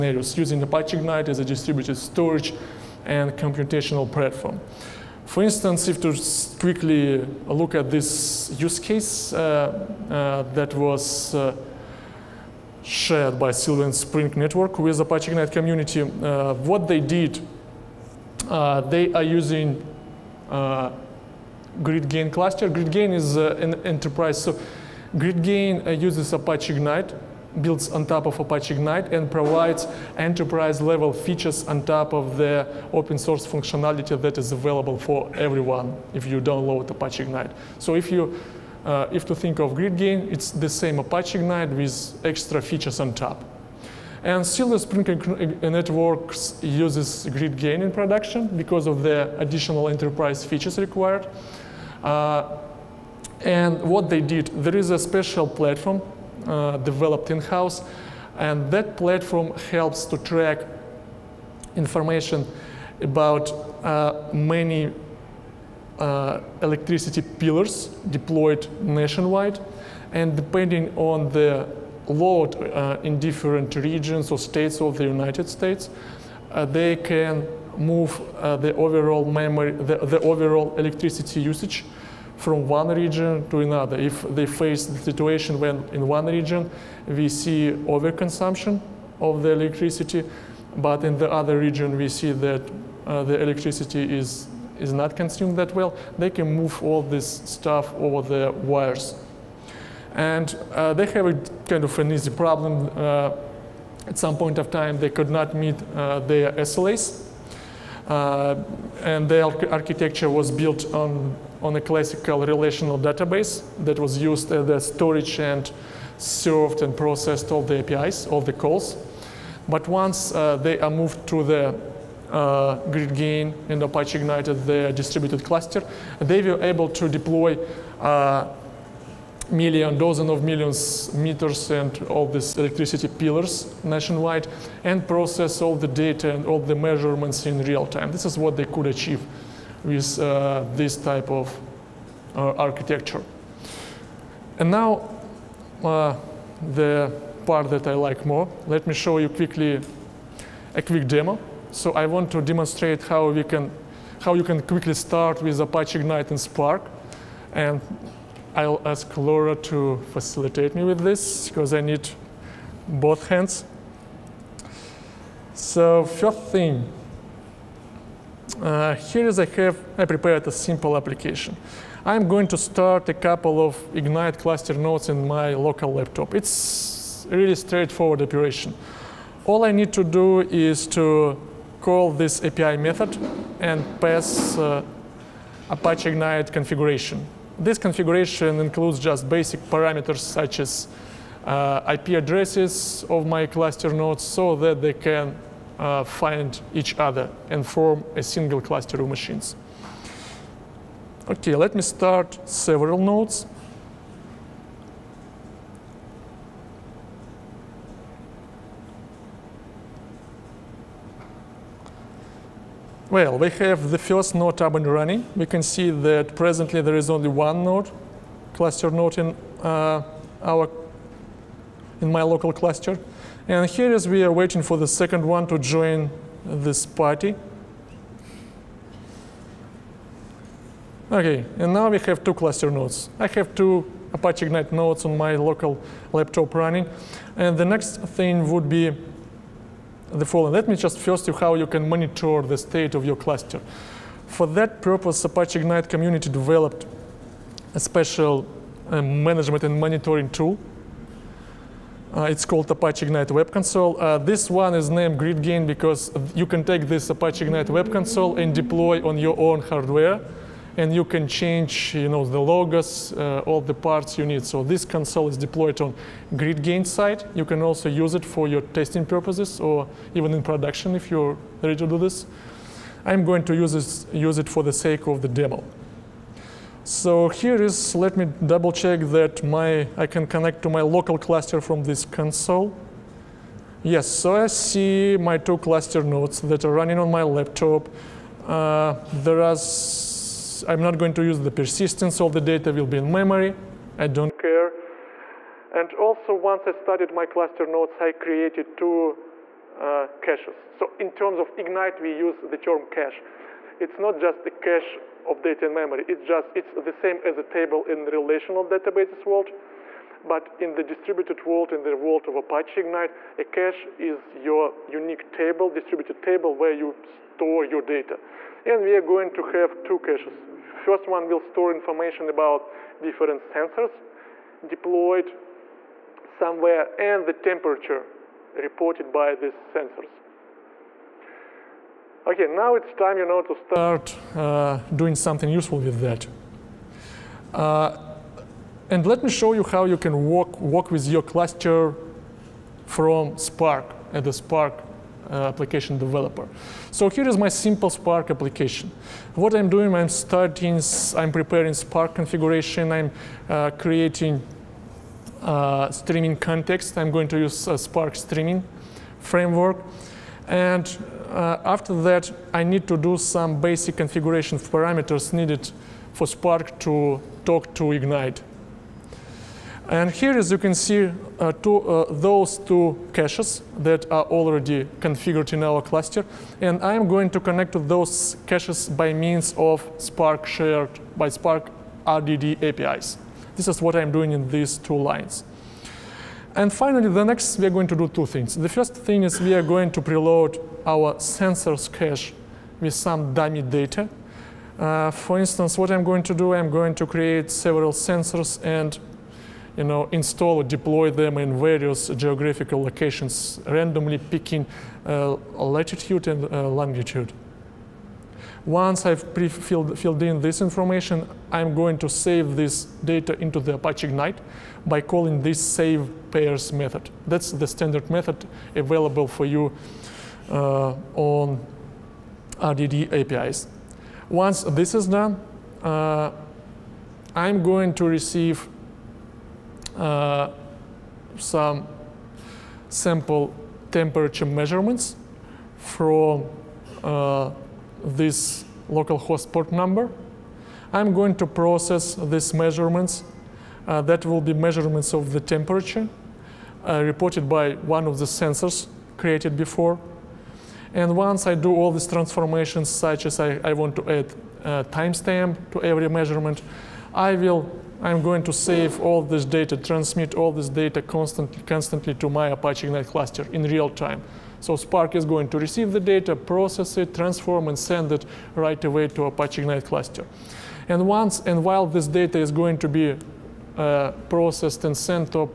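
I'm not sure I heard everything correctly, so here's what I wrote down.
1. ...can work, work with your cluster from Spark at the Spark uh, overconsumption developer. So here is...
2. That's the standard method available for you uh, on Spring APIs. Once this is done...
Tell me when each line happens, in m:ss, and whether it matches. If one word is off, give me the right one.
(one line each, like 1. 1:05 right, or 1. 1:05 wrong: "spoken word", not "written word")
1. 5:39 wrong: "application", not "overconsumption"
2. 6:57 wrong: "RDD", not "Spring".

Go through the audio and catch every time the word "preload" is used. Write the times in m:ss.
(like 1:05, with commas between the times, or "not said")
6:30.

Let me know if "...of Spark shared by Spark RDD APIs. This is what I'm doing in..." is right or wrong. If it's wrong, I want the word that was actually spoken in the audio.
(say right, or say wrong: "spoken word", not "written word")
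right.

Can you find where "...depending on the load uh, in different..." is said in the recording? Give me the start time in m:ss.
1:10.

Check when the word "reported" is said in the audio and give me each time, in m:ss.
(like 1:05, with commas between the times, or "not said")
5:28, 7:27.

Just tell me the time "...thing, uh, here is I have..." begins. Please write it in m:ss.
2:46.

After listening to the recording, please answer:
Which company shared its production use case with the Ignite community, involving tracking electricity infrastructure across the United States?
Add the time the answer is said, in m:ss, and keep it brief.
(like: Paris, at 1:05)
Silver Spring Networks, at 0:13.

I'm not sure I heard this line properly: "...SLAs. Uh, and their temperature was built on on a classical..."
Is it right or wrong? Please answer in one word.
wrong.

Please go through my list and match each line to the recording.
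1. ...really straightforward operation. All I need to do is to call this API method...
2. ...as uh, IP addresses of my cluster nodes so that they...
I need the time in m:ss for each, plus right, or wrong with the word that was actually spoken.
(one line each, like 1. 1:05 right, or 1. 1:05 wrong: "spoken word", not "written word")
1. 2:57 right
2. 3:10 right.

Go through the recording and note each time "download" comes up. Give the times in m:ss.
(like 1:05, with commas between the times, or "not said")
0:36.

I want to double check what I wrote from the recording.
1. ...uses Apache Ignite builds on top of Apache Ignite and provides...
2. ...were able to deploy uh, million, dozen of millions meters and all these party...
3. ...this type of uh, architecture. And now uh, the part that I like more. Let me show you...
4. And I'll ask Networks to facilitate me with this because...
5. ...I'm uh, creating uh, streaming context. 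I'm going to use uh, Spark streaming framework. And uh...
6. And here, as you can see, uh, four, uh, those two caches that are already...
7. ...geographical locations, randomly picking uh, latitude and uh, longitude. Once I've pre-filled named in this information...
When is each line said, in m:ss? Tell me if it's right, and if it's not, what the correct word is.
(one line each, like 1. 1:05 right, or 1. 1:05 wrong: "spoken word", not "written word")
1. 0:26 right
2. 2:06 wrong: "electricity", not "party"
3. 2:20 right
4. 2:37 wrong: "Laura", not "Networks"
5. 5:52 right
6. 6:09 wrong: "two", not "four"
7. 6:42 wrong: "filled", not "named".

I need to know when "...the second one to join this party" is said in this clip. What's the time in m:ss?
3:44.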